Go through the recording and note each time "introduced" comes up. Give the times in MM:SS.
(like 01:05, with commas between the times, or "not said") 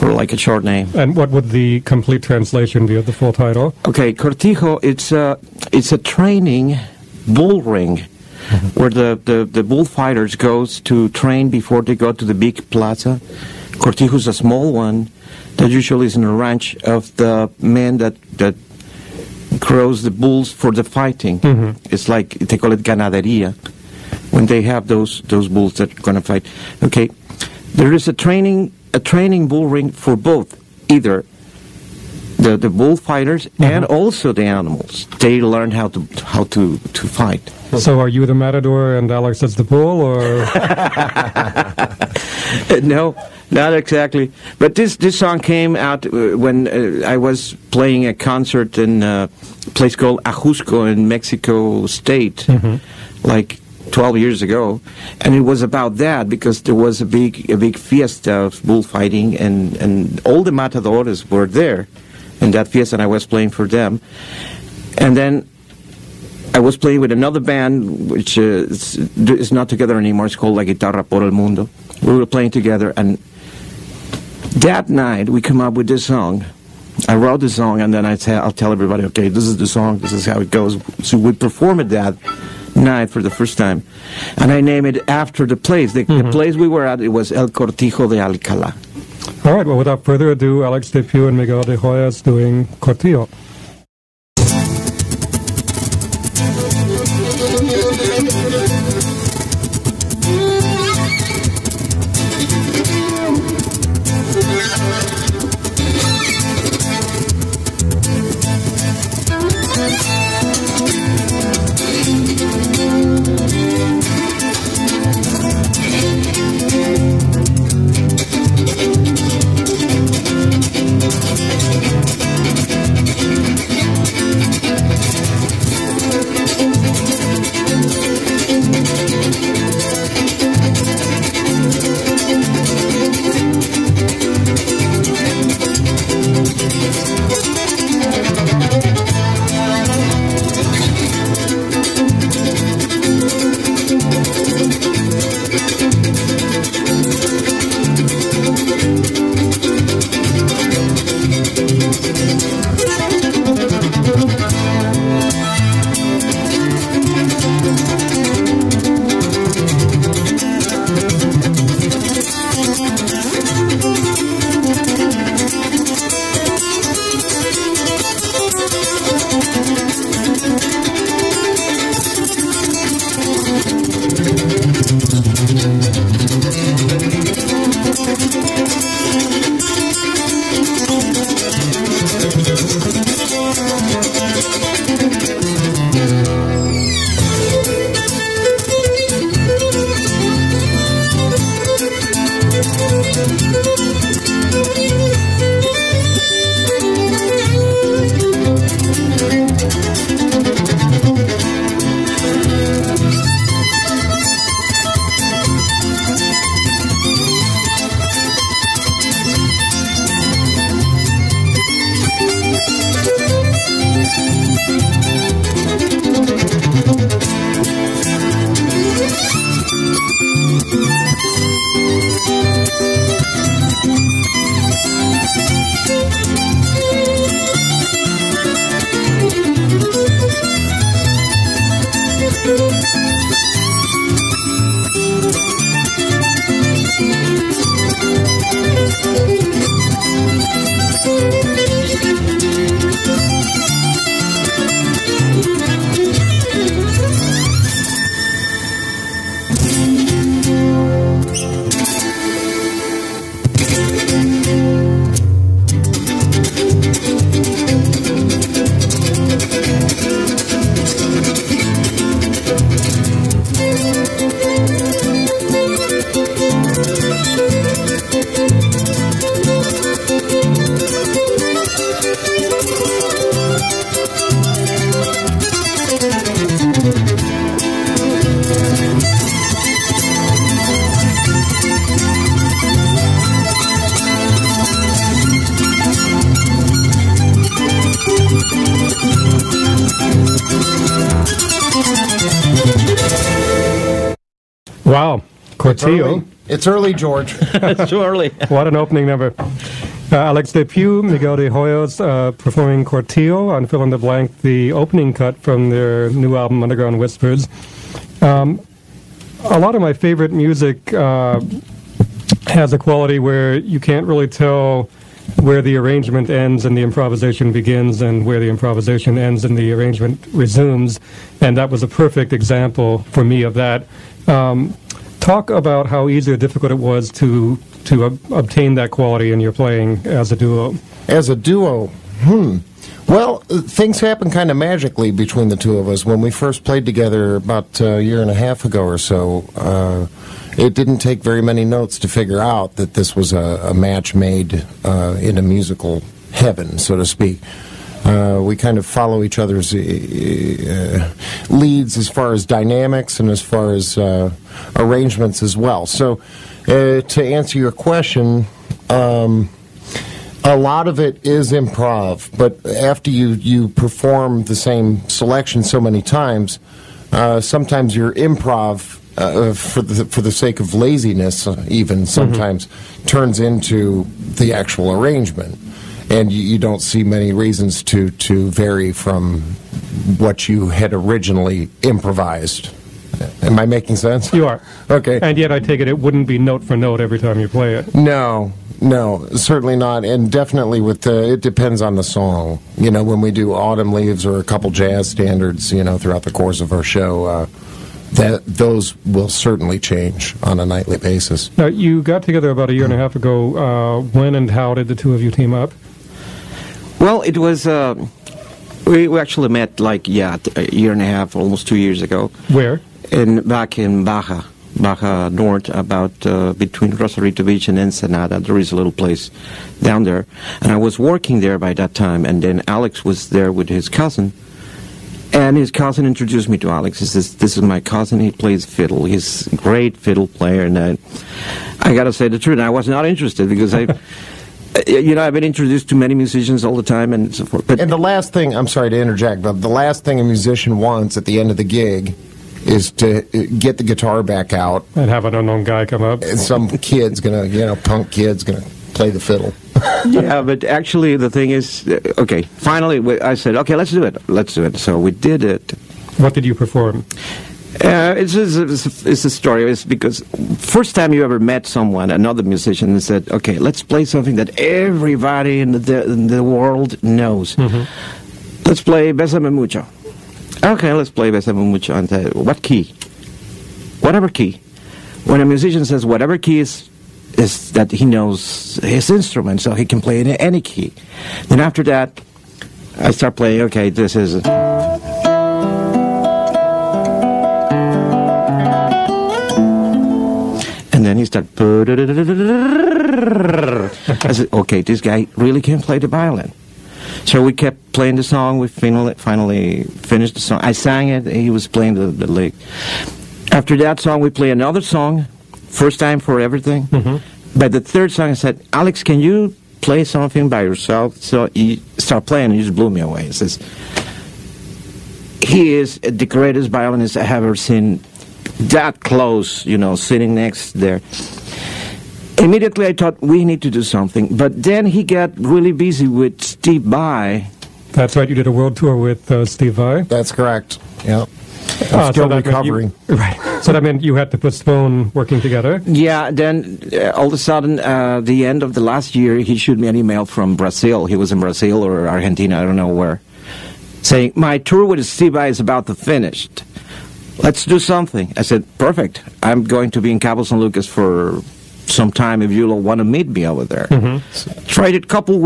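07:06, 07:15.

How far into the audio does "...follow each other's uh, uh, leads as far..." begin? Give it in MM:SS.
05:48.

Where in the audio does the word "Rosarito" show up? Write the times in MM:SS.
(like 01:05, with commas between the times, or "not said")
06:56.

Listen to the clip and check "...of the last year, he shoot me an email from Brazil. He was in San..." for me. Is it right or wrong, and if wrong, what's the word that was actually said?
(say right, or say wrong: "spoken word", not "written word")
wrong: "Brazil", not "San".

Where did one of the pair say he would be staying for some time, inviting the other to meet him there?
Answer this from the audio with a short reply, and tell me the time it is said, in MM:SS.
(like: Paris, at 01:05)
Cabo San Lucas, at 09:10.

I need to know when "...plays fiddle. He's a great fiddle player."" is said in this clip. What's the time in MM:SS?
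07:08.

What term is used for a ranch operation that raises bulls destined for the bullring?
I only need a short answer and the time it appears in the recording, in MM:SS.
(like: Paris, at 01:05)
ganaderia, at 00:22.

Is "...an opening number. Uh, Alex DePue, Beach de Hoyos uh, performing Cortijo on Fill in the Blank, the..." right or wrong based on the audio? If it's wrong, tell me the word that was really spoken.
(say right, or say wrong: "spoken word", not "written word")
wrong: "Miguel", not "Beach".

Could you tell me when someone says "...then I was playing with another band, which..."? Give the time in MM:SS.
01:05.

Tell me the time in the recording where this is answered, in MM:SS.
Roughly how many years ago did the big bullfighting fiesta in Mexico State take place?
00:53.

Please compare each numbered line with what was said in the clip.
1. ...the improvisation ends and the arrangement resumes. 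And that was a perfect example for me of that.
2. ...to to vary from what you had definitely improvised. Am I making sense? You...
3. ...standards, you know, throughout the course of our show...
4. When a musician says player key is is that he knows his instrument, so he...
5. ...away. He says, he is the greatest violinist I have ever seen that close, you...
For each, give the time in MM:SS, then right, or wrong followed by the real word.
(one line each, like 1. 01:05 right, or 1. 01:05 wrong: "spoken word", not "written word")
1. 05:18 right
2. 06:17 wrong: "originally", not "definitely"
3. 06:35 right
4. 07:55 wrong: "whatever", not "player"
5. 08:33 right.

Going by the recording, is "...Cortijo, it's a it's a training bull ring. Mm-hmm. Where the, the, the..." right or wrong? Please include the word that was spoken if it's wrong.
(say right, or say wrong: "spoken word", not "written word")
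right.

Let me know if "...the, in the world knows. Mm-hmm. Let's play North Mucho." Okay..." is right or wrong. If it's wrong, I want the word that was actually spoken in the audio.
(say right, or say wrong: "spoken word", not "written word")
wrong: "Besame", not "North".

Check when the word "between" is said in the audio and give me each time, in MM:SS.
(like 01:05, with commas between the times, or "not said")
05:35, 06:56.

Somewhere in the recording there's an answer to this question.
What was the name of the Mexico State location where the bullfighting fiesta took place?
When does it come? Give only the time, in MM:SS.
00:50.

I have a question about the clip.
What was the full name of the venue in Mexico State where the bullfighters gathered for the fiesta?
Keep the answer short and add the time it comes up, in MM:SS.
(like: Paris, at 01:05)
El Cortijo de Alcalá, at 01:27.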